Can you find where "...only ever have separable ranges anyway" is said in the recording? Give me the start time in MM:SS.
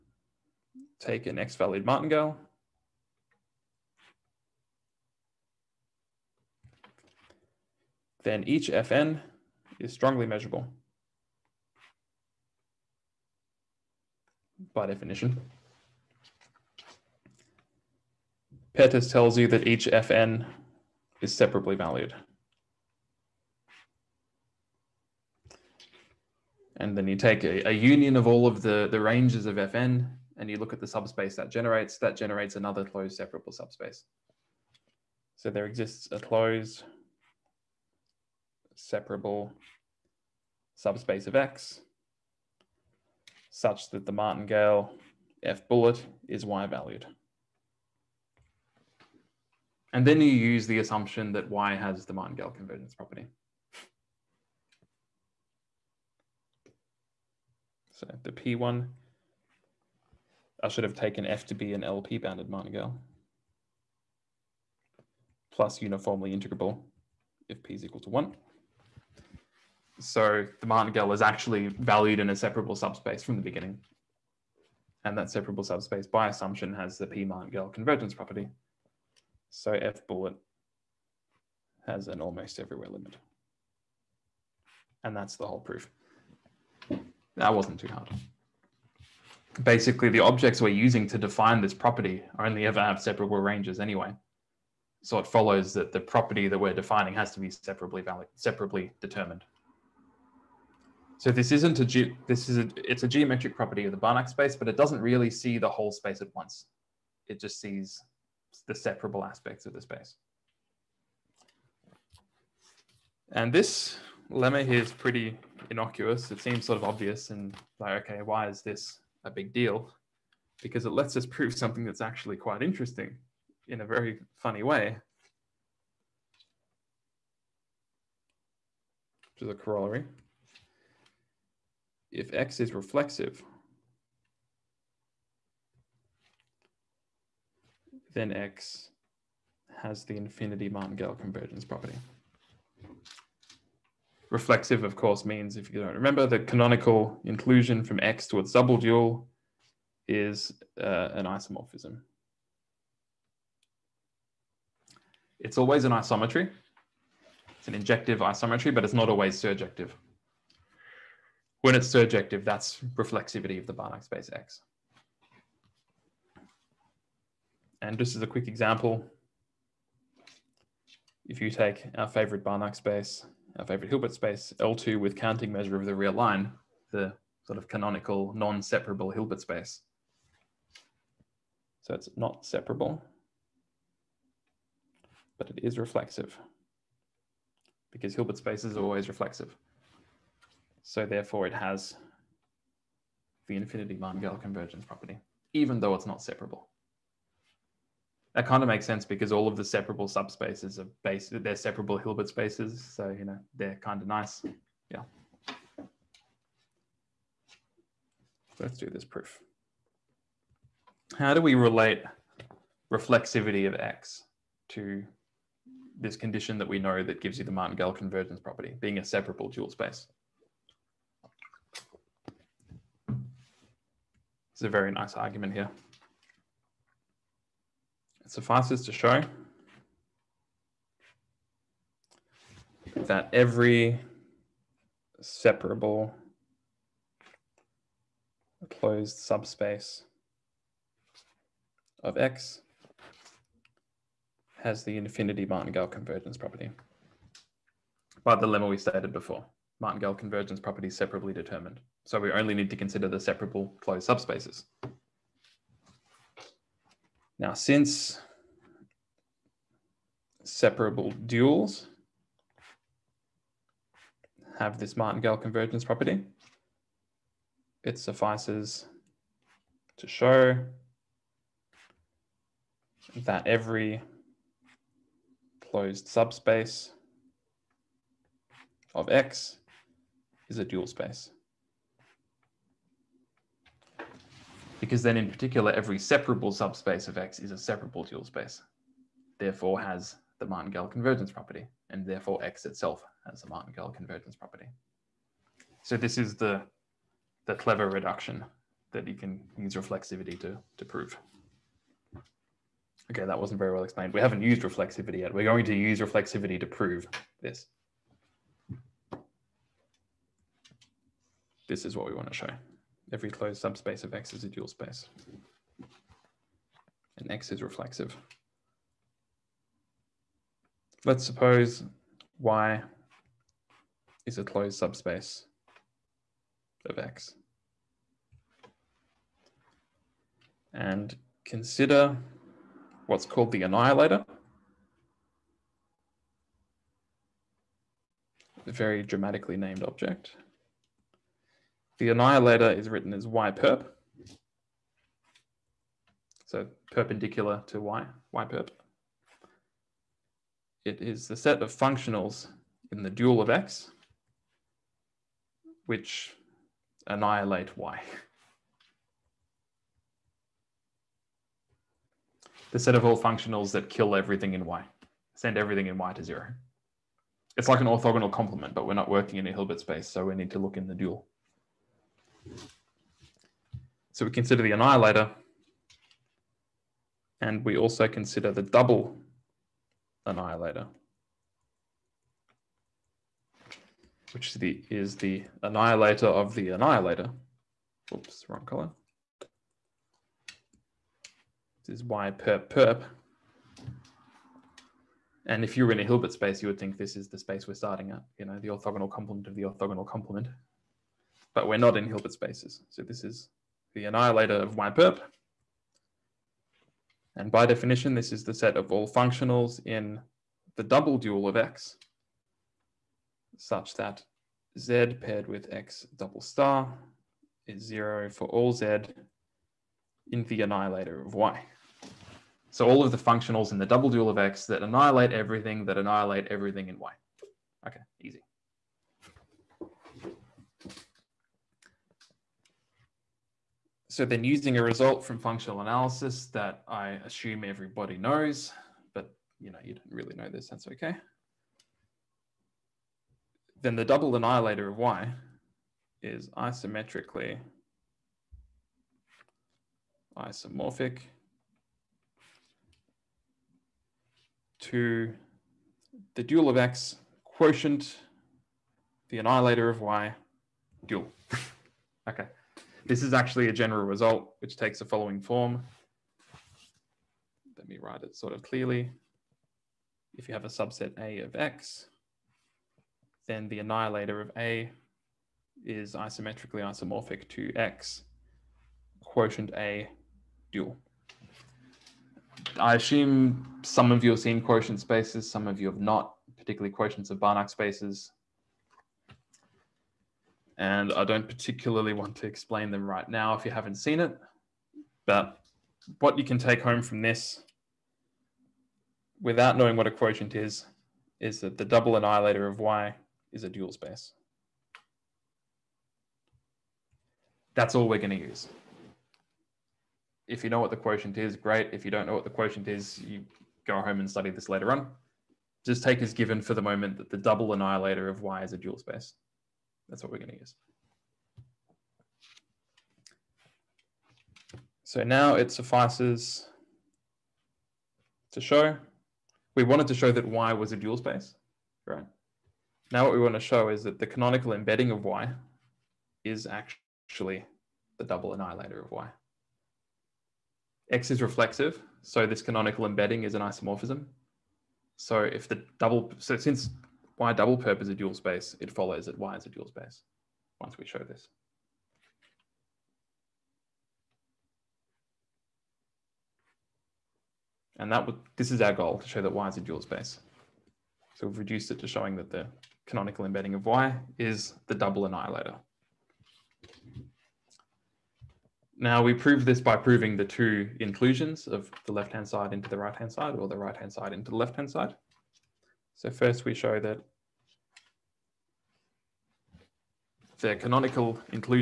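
01:32.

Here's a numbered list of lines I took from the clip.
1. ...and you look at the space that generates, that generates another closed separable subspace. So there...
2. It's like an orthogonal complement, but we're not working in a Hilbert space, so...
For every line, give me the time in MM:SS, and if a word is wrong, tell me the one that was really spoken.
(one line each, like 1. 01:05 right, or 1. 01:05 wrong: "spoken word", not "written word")
1. 00:30 wrong: "subspace", not "space"
2. 06:07 right.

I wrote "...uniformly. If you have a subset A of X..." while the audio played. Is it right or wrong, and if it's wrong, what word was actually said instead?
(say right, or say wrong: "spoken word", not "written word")
wrong: "clearly", not "uniformly".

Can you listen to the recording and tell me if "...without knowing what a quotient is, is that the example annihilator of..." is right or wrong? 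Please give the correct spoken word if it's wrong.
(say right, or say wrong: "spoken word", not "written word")
wrong: "double", not "example".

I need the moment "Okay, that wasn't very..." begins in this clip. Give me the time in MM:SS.
05:03.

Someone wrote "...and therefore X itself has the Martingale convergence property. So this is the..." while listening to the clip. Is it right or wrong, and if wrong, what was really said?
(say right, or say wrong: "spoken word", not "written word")
right.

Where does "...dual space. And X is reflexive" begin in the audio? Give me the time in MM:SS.
05:14.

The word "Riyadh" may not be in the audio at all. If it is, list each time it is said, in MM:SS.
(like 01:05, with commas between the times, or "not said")
not said.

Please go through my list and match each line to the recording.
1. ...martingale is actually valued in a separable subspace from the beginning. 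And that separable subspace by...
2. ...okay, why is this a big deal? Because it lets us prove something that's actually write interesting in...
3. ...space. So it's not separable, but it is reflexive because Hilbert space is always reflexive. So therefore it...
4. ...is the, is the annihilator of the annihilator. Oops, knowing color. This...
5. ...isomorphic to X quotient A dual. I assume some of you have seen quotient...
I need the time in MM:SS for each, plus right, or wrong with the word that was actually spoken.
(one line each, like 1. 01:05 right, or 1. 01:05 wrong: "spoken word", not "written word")
1. 01:10 right
2. 01:58 wrong: "quite", not "write"
3. 02:59 right
4. 06:24 wrong: "wrong", not "knowing"
5. 07:56 right.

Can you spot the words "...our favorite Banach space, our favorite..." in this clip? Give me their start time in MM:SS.
02:51.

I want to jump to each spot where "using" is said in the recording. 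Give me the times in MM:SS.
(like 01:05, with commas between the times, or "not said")
01:30, 07:14.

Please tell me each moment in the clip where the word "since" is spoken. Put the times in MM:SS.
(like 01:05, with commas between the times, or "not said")
04:17, 09:06.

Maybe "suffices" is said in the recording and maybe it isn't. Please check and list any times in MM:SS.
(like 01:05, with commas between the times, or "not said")
03:48, 04:27, 08:45.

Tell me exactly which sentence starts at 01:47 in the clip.
It just sees the separable aspects of the space.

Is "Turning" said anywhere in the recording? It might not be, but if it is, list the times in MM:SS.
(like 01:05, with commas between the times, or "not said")
not said.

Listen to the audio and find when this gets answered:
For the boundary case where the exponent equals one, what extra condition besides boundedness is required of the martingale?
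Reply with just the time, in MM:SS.
01:05.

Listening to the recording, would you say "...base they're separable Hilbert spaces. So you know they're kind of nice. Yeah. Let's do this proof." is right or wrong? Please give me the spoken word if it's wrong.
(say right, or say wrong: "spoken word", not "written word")
right.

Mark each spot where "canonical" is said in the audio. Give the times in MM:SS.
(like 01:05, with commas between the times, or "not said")
02:26, 02:57, 08:54, 09:02, 09:23, 09:40.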